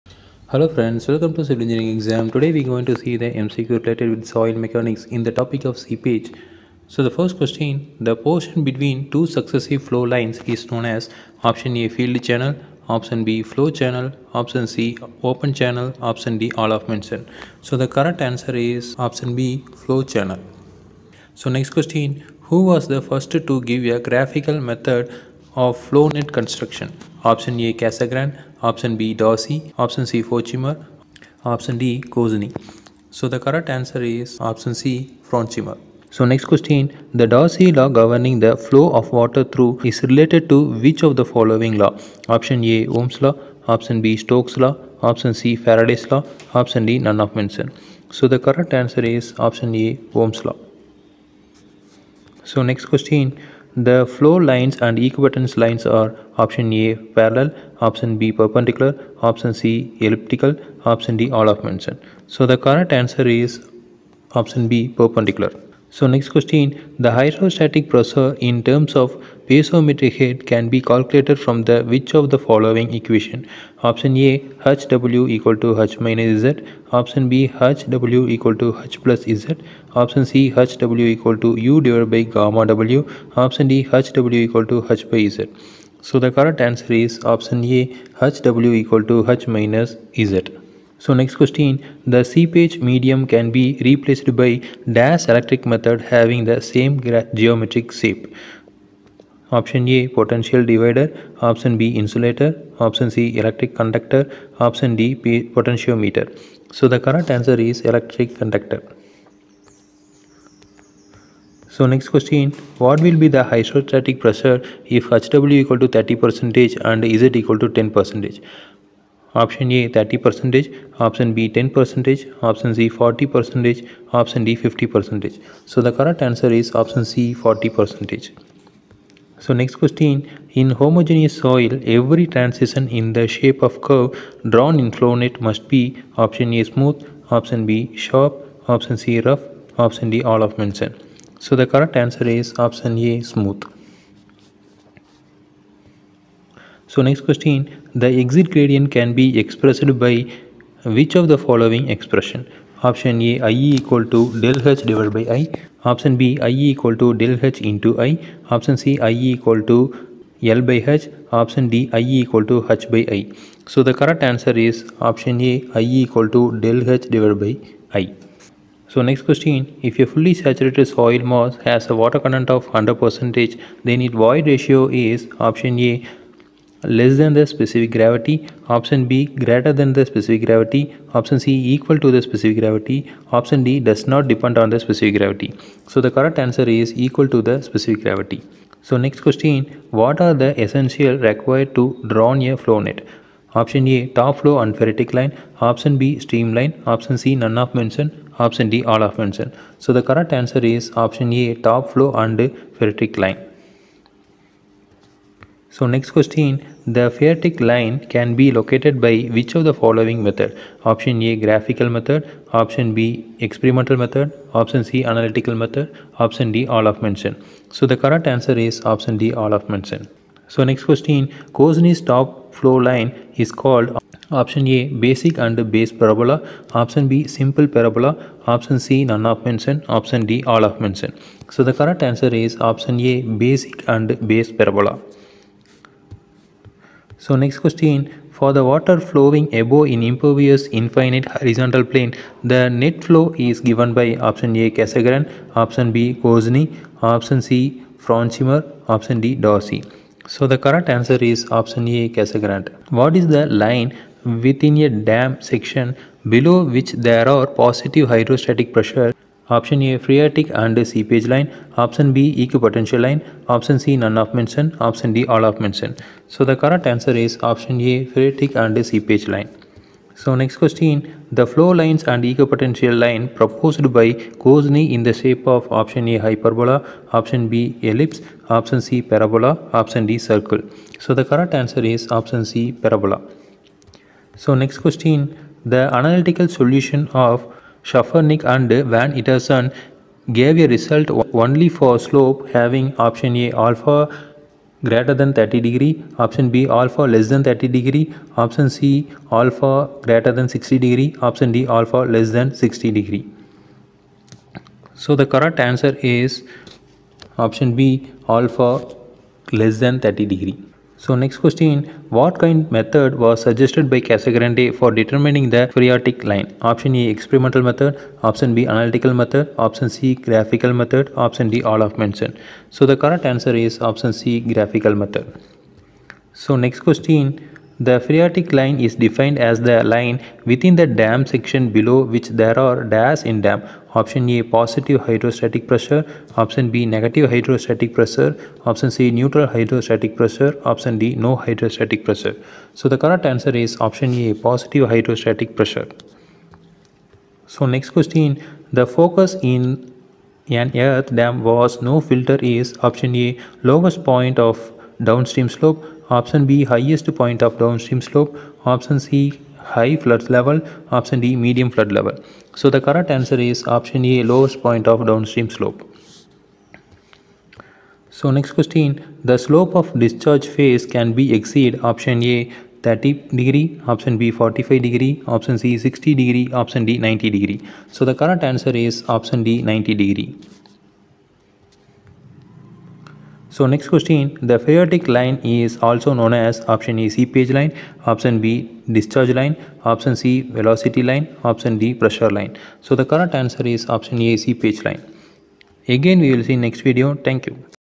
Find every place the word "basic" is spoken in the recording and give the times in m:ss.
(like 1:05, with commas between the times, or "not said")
3:44, 3:53.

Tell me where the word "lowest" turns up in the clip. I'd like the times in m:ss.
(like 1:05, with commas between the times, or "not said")
5:53, 6:04.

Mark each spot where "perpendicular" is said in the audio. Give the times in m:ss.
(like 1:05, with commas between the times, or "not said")
0:58, 1:04.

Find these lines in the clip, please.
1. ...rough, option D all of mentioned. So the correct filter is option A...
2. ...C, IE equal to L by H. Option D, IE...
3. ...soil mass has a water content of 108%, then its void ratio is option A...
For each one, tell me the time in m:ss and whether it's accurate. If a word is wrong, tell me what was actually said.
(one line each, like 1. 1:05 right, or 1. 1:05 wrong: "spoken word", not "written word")
1. 2:19 wrong: "answer", not "filter"
2. 2:38 right
3. 2:50 wrong: "100", not "108".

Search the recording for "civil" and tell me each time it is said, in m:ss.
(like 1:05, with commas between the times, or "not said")
0:01.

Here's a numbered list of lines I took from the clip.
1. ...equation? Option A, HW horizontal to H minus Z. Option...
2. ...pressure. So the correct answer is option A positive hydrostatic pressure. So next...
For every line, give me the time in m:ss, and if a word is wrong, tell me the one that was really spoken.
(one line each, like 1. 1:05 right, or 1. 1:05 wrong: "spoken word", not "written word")
1. 1:12 wrong: "equal", not "horizontal"
2. 5:42 right.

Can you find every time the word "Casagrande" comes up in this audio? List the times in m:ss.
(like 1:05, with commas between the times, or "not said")
0:27, 4:04, 4:12, 5:14.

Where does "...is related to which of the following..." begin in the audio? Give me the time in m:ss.
0:39.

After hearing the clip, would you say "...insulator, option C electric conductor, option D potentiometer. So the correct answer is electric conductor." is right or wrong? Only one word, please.
right.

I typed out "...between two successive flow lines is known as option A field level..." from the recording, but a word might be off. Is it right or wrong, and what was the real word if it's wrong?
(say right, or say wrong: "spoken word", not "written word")
wrong: "channel", not "level".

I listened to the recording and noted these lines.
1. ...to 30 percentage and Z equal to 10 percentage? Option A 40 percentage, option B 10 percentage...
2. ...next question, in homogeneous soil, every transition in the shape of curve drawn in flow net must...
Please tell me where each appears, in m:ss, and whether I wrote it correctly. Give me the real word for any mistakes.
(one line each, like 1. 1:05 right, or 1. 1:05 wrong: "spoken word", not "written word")
1. 1:55 wrong: "30", not "40"
2. 2:09 right.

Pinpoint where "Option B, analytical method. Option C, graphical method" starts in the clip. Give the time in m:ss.
5:18.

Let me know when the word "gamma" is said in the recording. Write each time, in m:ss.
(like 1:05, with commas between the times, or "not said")
1:22.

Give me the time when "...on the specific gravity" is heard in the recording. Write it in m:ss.
3:04.